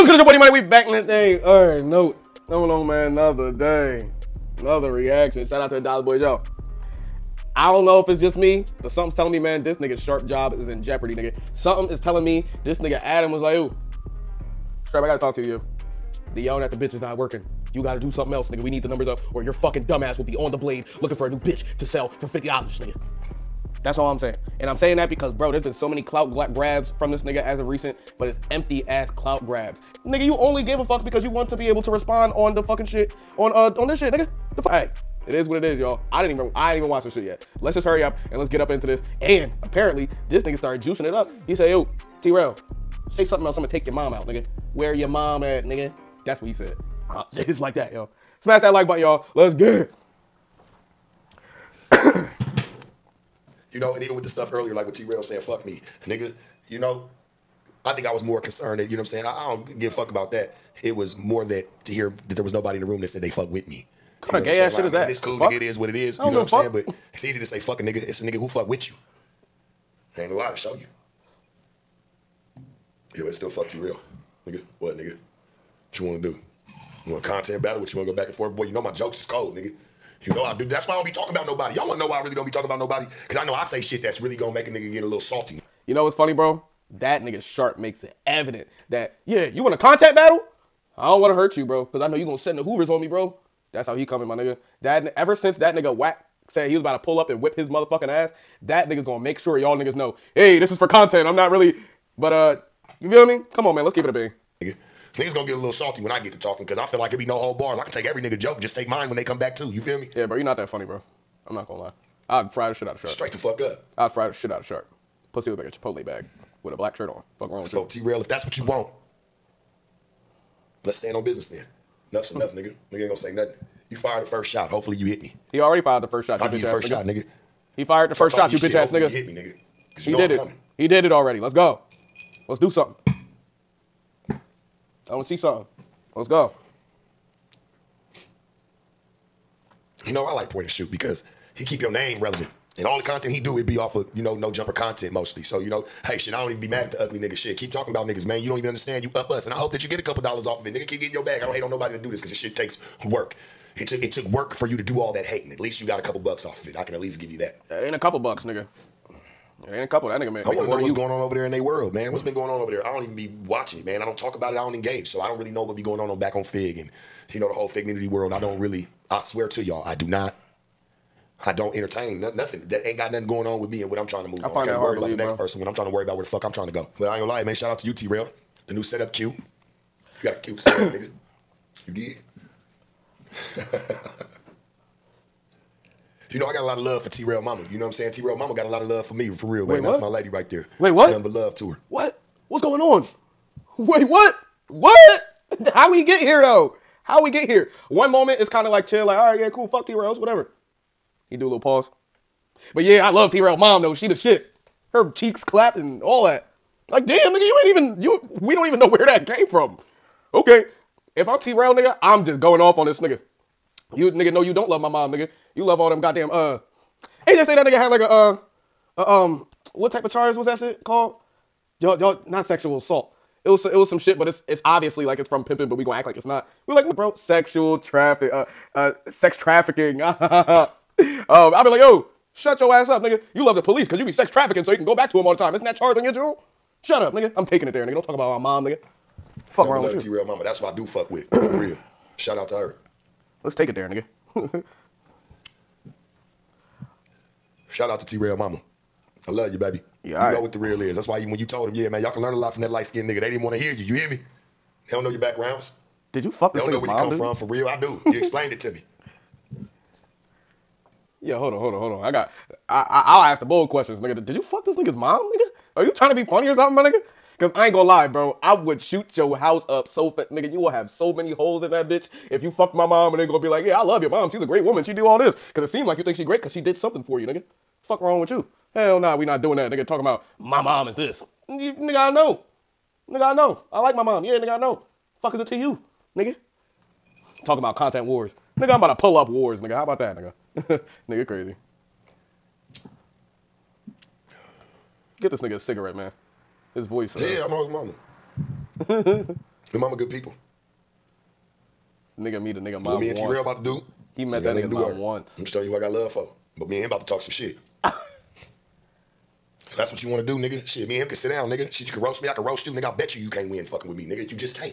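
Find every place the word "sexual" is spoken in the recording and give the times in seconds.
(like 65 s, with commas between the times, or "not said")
222 s, 227 s.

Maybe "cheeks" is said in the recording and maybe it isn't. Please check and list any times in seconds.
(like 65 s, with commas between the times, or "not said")
205 s.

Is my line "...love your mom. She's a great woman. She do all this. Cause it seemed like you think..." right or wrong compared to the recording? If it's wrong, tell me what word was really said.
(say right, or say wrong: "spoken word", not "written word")
right.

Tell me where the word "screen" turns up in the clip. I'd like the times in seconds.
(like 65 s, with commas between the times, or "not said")
not said.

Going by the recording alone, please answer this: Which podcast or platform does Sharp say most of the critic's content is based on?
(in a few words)
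No Jumper.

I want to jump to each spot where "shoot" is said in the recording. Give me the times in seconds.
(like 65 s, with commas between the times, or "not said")
140 s, 268 s.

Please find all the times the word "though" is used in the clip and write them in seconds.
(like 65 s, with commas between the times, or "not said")
196 s, 203 s.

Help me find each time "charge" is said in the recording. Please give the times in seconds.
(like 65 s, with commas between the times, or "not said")
220 s, 235 s.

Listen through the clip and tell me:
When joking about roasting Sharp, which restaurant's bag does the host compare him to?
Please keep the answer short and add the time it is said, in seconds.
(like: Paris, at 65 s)
Chipotle, at 115 s.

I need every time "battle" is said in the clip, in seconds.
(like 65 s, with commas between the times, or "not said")
77 s, 90 s.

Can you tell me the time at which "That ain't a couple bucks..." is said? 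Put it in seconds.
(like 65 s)
157 s.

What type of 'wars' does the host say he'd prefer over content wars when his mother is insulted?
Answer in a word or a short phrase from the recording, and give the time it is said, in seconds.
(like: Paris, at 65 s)
Pull up wars, at 289 s.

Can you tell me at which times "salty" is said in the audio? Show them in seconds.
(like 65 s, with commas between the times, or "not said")
85 s, 105 s.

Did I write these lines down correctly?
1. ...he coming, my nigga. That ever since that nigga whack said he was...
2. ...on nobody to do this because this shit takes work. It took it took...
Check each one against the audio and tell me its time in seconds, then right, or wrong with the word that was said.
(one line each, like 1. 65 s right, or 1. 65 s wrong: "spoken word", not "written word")
1. 93 s right
2. 151 s right.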